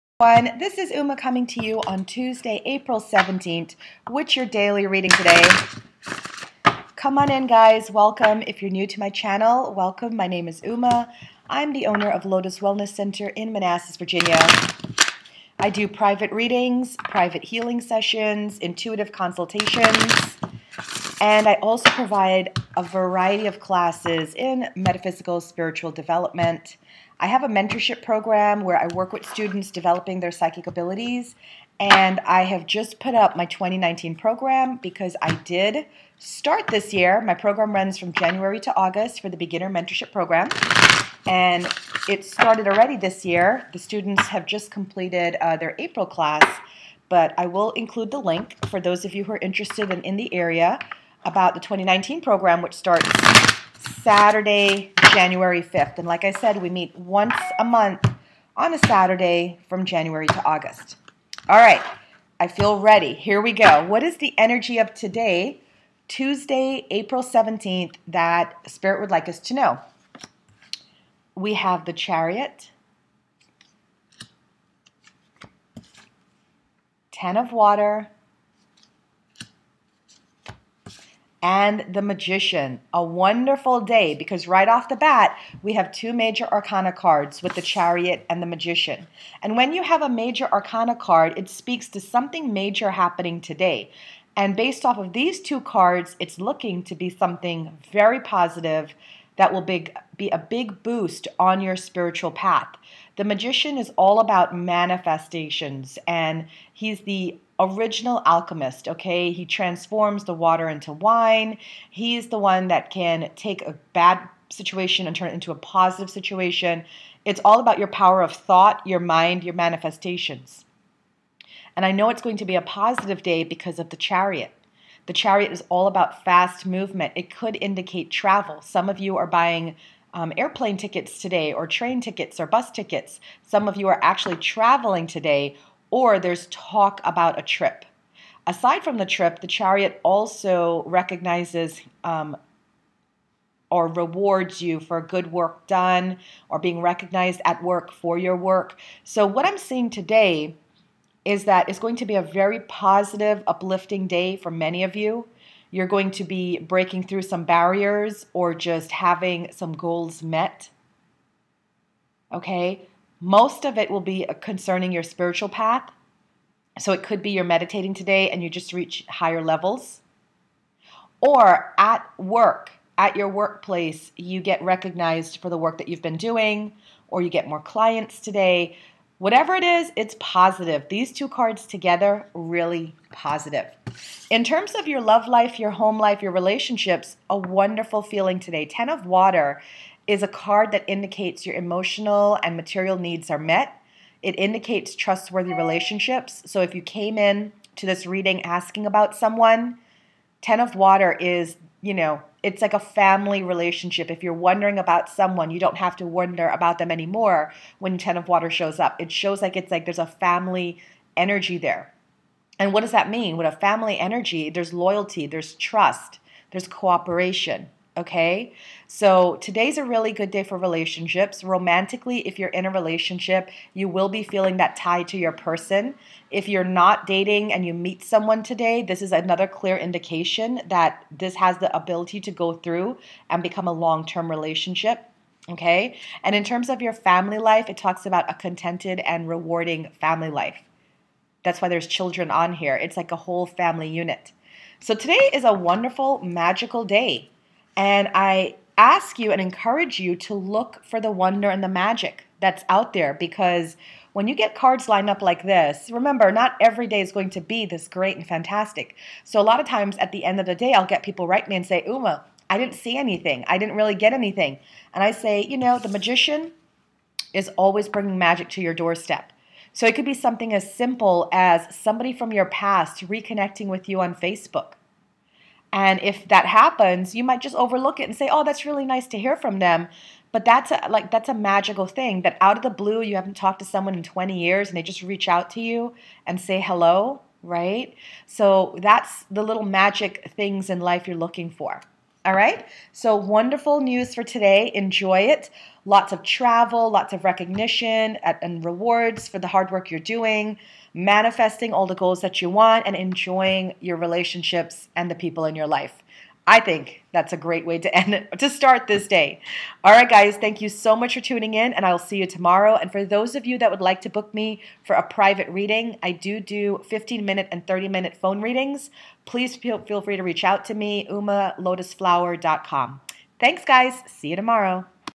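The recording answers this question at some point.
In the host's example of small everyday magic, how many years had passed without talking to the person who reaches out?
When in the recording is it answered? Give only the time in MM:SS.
04:44.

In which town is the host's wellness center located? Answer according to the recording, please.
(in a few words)
Manassas, Virginia.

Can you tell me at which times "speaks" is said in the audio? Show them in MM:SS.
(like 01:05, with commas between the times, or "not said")
01:31.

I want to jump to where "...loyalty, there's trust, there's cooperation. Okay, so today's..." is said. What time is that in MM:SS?
03:34.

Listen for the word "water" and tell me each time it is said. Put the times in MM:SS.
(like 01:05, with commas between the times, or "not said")
01:17, 01:50, 03:09, 03:20, 03:28.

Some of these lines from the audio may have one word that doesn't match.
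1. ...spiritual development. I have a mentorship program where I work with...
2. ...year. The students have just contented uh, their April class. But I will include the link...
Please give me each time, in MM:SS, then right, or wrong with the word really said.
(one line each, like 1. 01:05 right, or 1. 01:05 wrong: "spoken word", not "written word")
1. 00:25 right
2. 00:43 wrong: "completed", not "contented".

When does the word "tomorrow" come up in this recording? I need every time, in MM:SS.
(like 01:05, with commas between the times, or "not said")
05:12, 05:24.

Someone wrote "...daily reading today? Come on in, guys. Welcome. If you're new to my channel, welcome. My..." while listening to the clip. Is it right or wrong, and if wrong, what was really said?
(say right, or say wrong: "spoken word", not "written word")
right.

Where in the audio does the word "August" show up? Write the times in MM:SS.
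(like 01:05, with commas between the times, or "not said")
00:38, 01:00.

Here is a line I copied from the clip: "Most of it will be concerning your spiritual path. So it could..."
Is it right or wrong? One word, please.
right.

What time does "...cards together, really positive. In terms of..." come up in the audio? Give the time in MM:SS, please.
03:01.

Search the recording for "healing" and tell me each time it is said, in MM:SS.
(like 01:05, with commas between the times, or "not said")
00:17.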